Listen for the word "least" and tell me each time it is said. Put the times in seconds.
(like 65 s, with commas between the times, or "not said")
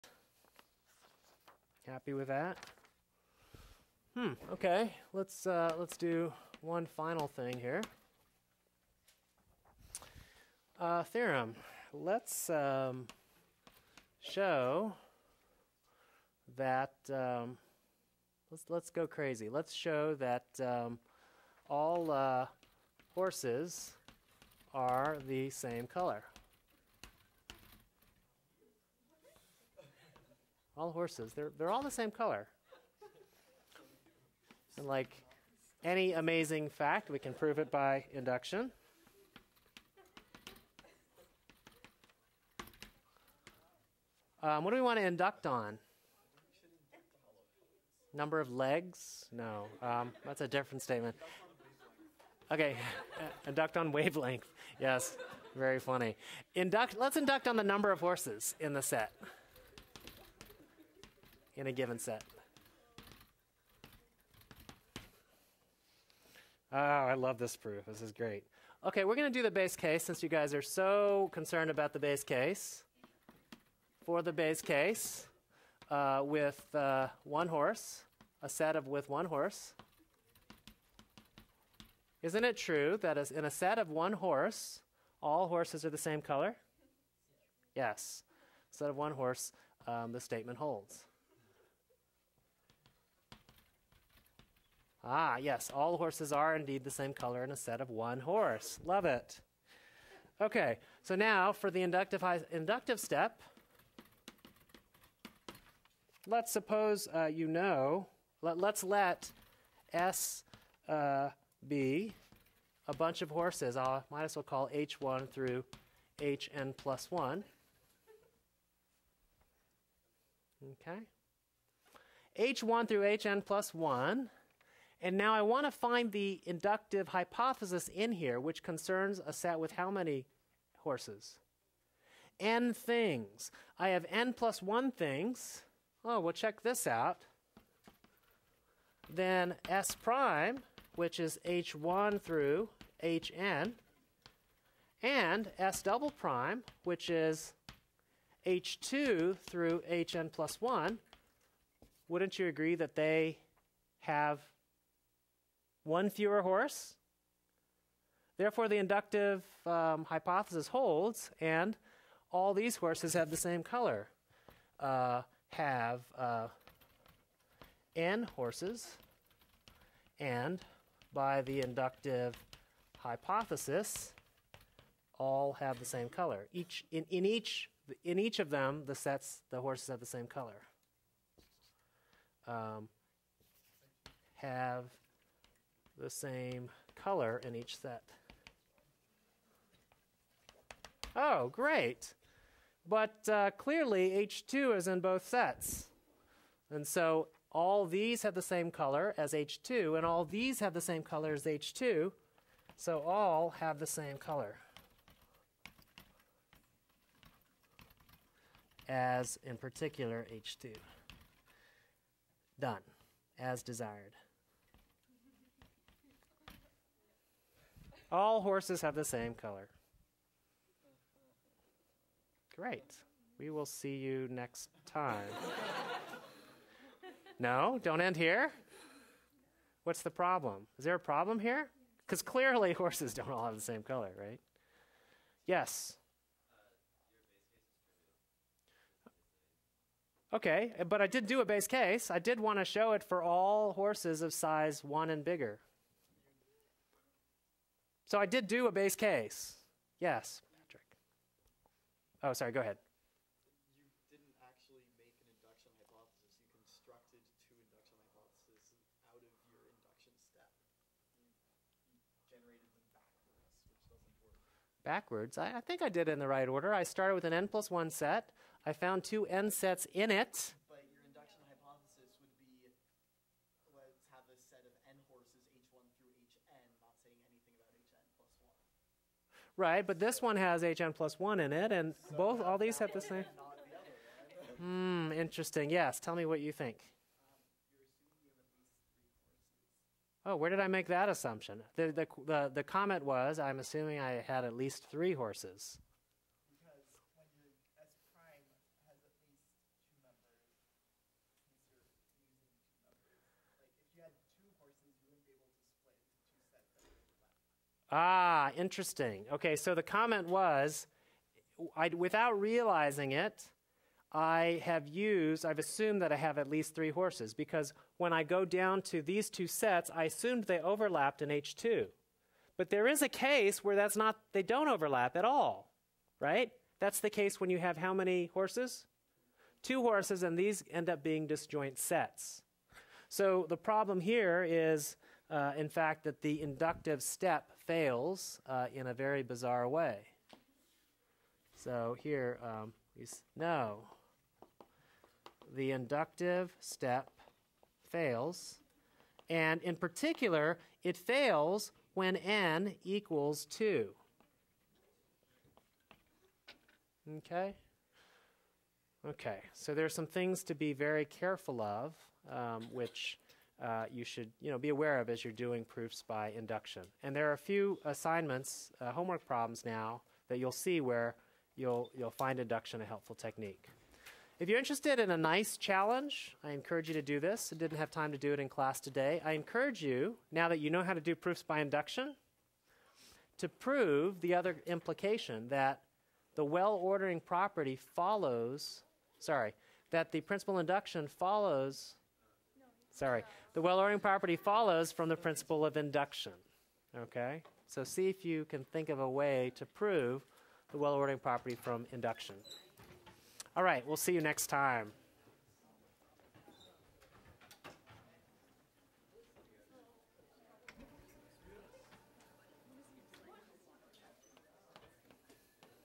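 294 s, 316 s.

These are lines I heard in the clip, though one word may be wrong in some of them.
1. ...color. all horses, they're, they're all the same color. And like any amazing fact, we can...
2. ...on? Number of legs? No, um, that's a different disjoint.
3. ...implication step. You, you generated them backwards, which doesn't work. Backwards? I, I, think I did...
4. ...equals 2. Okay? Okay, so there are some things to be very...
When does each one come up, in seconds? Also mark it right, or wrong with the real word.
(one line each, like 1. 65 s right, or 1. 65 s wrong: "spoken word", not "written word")
1. 25 s right
2. 45 s wrong: "statement", not "disjoint"
3. 259 s wrong: "induction", not "implication"
4. 352 s right.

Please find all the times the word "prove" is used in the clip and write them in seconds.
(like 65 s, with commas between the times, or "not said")
37 s, 383 s, 399 s.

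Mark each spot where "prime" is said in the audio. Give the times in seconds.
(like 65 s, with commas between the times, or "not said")
139 s, 146 s.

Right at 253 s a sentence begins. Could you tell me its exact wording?
You didn't actually make an induction hypothesis.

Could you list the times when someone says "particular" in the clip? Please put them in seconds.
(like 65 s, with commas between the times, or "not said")
209 s, 349 s.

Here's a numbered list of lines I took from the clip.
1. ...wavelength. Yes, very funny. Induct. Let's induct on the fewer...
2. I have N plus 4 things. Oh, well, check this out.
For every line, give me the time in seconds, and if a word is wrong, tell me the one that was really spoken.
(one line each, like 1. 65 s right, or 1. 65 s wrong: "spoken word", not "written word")
1. 53 s wrong: "number", not "fewer"
2. 133 s wrong: "1", not "4".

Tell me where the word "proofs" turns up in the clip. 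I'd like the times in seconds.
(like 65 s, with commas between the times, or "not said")
67 s, 365 s, 381 s.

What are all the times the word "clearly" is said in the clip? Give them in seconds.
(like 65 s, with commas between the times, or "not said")
193 s, 232 s.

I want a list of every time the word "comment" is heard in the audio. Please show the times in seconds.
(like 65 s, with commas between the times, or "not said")
292 s, 309 s.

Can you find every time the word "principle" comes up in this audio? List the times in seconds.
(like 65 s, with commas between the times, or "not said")
390 s, 395 s.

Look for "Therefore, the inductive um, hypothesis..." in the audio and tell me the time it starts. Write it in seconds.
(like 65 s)
158 s.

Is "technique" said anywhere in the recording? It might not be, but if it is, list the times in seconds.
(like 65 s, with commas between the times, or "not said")
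373 s.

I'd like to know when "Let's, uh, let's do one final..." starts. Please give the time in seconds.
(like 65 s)
5 s.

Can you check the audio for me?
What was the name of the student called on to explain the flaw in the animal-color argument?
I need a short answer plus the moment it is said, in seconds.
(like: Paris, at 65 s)
Patrick, at 250 s.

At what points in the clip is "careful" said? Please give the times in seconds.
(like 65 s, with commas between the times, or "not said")
361 s.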